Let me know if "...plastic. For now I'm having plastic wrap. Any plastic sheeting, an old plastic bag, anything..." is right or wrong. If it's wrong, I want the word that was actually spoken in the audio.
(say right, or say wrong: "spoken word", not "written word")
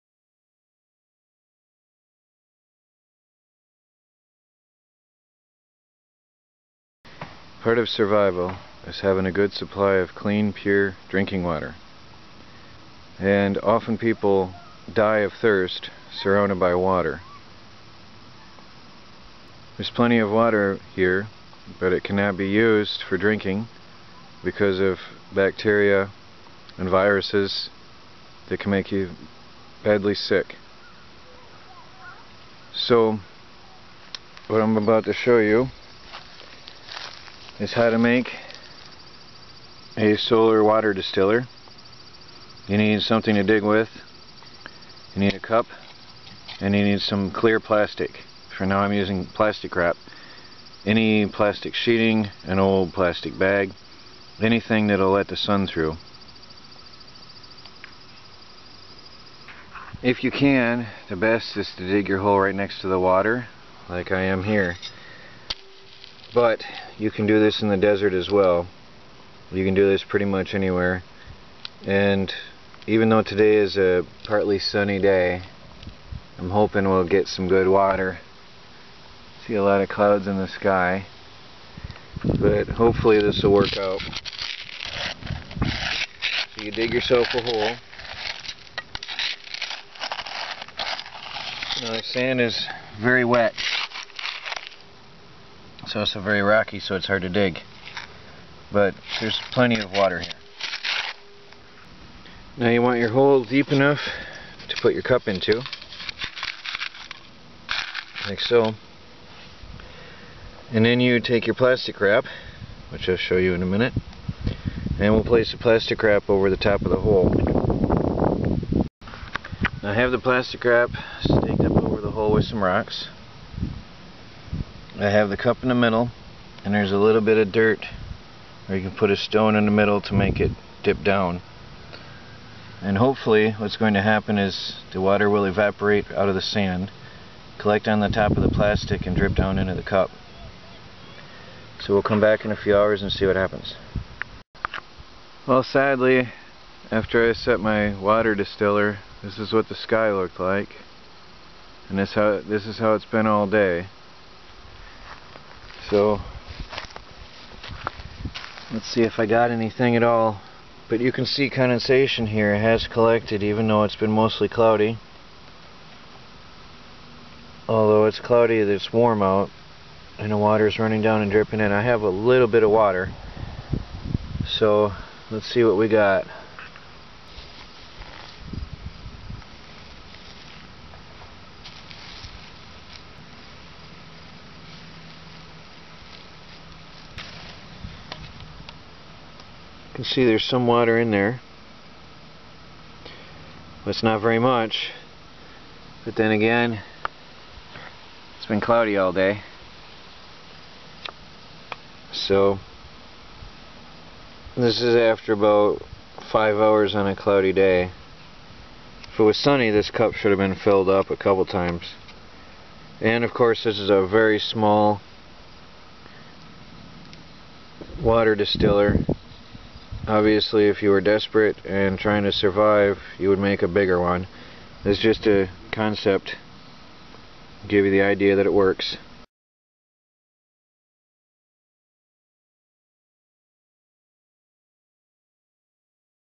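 wrong: "using", not "having".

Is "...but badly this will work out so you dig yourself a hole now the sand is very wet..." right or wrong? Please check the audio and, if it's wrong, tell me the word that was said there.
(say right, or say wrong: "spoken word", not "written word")
wrong: "hopefully", not "badly".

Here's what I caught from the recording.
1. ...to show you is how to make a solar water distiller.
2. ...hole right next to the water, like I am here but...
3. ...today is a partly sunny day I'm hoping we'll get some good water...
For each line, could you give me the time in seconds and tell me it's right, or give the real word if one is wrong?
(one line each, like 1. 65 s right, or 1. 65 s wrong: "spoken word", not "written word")
1. 35 s right
2. 62 s right
3. 73 s right.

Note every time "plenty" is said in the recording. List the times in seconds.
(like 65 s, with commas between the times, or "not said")
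19 s, 99 s.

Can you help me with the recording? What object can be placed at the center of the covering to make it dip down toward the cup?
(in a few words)
A stone.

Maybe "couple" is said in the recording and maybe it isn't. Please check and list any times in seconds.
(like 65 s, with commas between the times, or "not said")
211 s.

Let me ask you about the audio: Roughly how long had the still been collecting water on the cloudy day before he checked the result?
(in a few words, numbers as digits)
5 hours.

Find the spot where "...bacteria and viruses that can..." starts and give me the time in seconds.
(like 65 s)
25 s.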